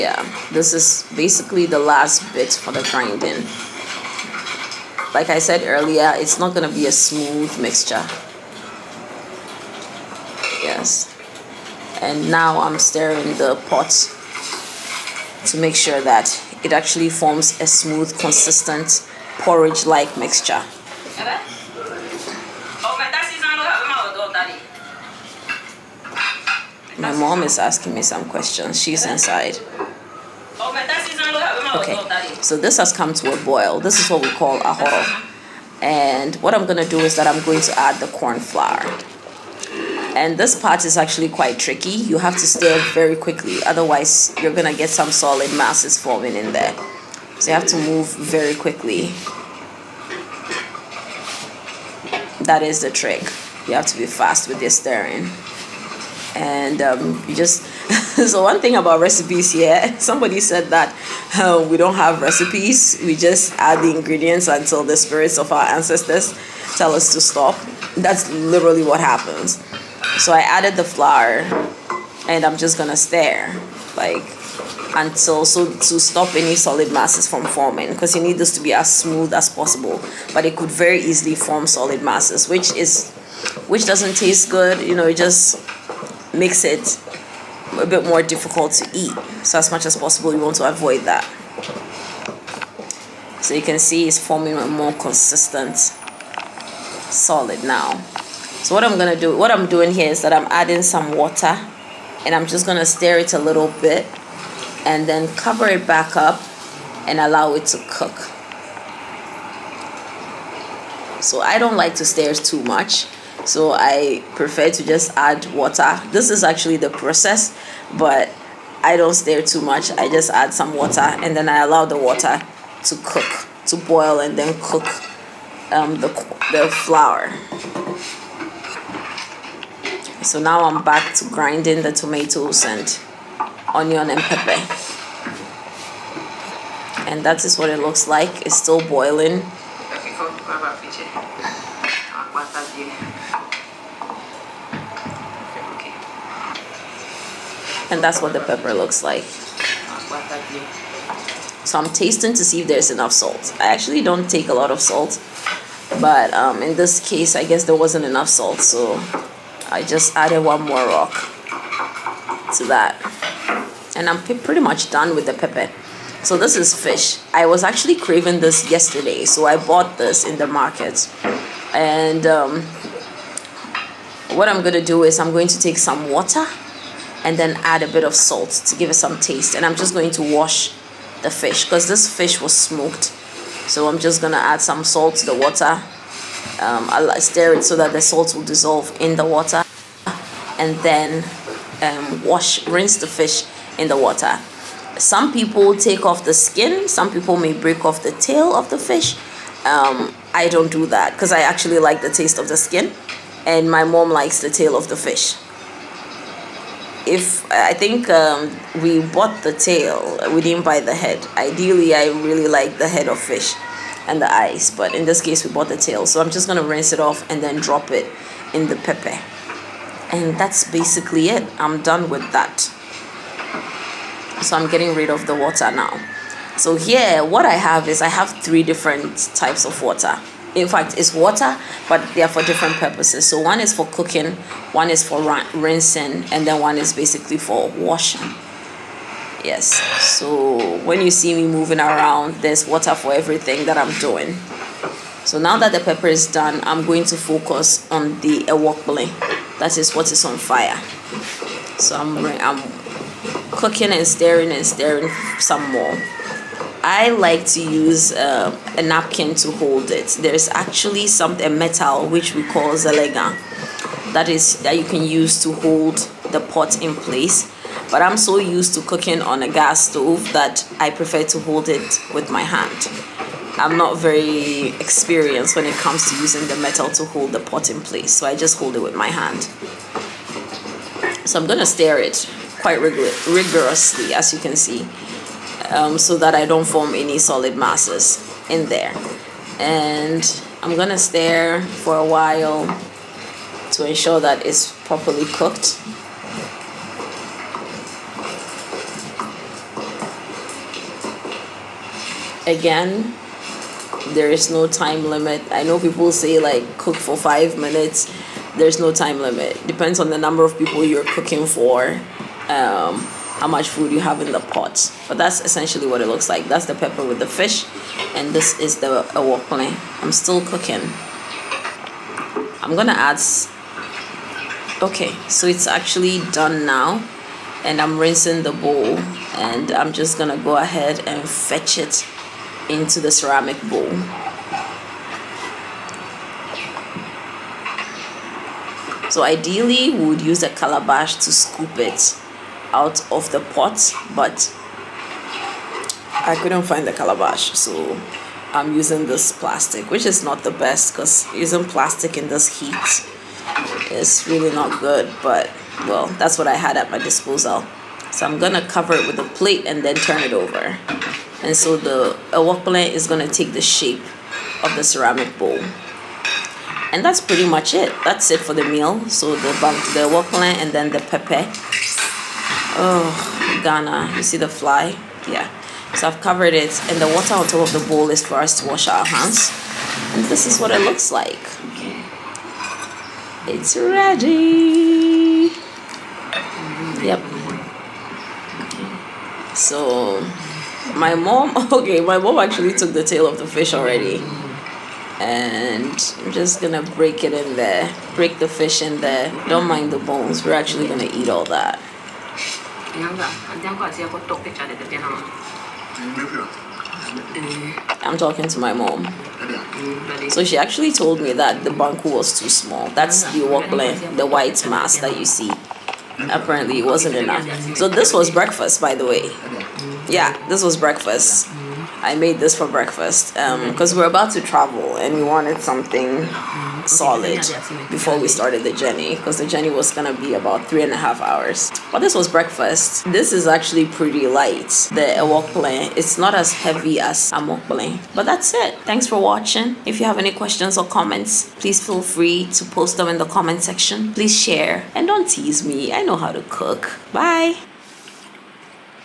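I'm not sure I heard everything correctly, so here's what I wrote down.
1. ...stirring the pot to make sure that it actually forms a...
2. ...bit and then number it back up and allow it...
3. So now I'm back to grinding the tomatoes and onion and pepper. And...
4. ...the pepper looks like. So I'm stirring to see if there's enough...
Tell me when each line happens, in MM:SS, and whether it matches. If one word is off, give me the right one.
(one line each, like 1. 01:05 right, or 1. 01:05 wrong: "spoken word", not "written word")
1. 00:12 right
2. 01:43 wrong: "cover", not "number"
3. 02:10 right
4. 02:28 wrong: "tasting", not "stirring".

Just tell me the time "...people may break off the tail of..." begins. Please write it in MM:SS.
03:17.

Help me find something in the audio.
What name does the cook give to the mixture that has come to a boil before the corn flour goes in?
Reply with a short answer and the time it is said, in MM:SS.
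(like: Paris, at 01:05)
horo, at 00:34.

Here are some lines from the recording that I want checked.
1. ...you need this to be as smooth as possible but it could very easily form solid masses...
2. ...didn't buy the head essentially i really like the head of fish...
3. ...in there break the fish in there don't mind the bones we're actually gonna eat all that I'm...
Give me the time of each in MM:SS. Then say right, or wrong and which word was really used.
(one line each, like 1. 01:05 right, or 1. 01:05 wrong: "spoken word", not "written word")
1. 01:18 right
2. 03:30 wrong: "ideally", not "essentially"
3. 06:37 right.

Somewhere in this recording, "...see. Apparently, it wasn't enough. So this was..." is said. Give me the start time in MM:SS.
06:55.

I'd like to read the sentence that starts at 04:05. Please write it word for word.
So now that the pepper is done, I'm going to focus on the ewokple.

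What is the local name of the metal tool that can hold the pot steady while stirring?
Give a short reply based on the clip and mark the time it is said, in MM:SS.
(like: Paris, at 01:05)
zelega, at 04:22.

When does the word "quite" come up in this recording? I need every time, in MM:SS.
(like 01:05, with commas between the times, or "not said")
00:41, 04:42.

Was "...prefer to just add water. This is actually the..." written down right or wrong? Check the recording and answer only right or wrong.
right.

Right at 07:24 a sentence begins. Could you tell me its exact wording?
Please share and don't tease me.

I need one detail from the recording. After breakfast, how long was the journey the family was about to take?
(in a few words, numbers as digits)
3 and a half hours.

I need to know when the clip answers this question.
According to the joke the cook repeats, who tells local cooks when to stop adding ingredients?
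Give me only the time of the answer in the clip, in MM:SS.
01:04.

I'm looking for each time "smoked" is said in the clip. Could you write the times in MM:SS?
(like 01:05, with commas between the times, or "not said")
03:02.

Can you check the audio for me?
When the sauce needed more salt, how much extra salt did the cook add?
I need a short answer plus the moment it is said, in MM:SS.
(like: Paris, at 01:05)
one more rock, at 02:40.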